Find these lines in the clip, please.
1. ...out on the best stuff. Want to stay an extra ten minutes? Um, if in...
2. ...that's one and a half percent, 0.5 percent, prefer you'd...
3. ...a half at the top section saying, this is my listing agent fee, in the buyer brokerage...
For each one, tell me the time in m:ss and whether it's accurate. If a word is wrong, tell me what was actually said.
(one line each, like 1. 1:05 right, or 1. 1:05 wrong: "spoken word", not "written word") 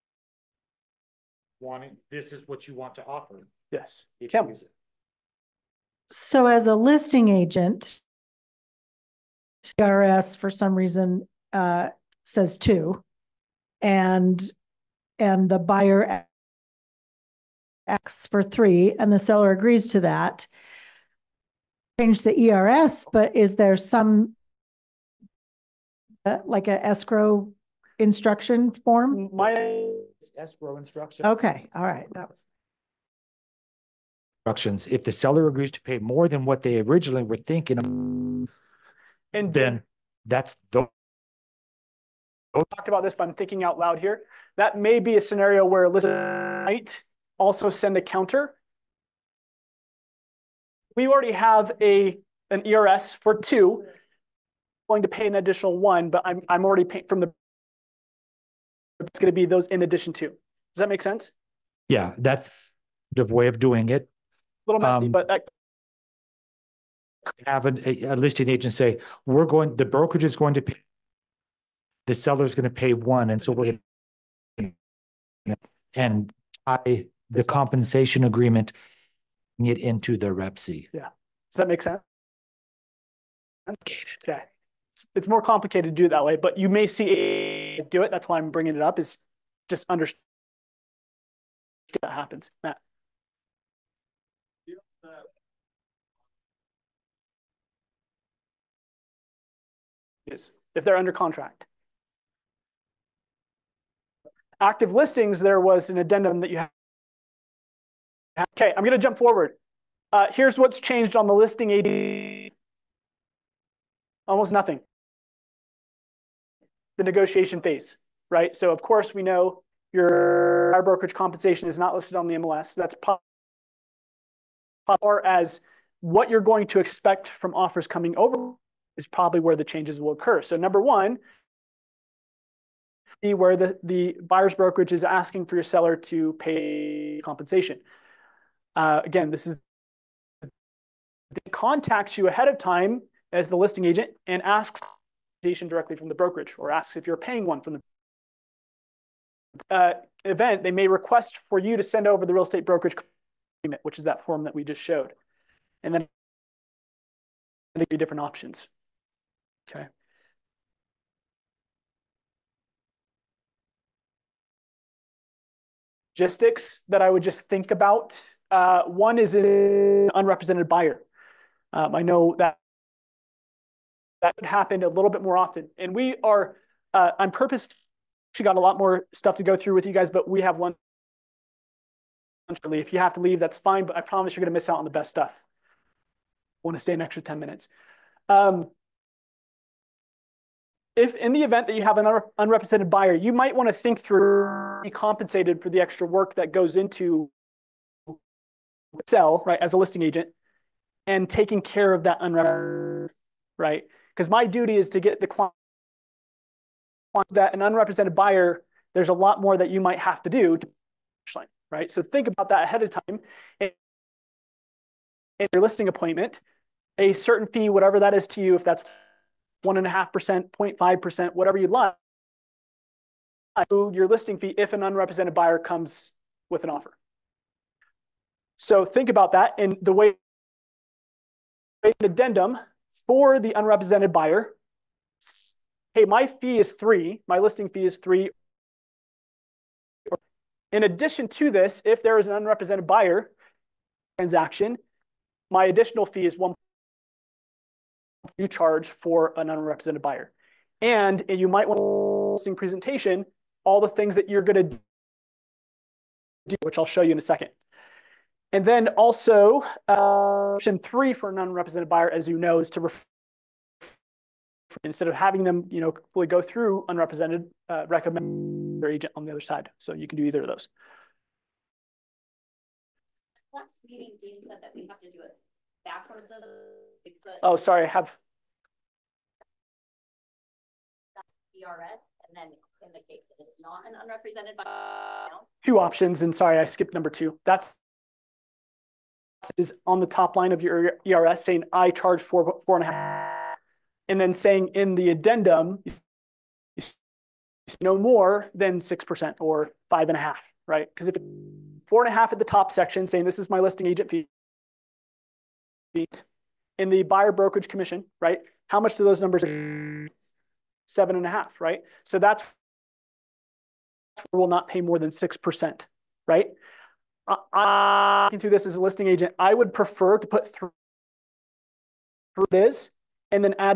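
1. 3:04 right
2. 3:38 wrong: "whatever", not "prefer"
3. 5:02 right.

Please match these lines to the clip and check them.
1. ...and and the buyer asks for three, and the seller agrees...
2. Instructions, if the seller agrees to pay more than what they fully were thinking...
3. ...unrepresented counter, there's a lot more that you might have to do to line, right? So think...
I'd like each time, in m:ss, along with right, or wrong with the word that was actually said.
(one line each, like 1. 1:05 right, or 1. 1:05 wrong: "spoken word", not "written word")
1. 0:13 right
2. 0:34 wrong: "originally", not "fully"
3. 3:27 wrong: "buyer", not "counter".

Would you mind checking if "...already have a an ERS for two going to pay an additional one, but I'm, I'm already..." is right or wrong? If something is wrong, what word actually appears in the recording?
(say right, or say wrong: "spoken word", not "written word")
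right.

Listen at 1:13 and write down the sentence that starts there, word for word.
And so we're and tie the compensation agreement it into the C.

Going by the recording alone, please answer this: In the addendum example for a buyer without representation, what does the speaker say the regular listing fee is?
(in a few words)
3.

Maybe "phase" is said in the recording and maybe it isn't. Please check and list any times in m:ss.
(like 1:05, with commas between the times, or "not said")
1:57.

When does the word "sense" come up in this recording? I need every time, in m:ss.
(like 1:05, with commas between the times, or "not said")
1:01, 1:21.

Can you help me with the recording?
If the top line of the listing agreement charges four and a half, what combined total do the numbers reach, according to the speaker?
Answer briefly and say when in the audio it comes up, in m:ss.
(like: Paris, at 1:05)
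7.5, at 5:10.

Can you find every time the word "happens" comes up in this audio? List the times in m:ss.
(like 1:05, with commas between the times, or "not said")
1:32, 2:54.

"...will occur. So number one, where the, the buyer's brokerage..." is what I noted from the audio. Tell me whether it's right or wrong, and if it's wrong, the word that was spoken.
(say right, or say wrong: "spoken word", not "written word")
right.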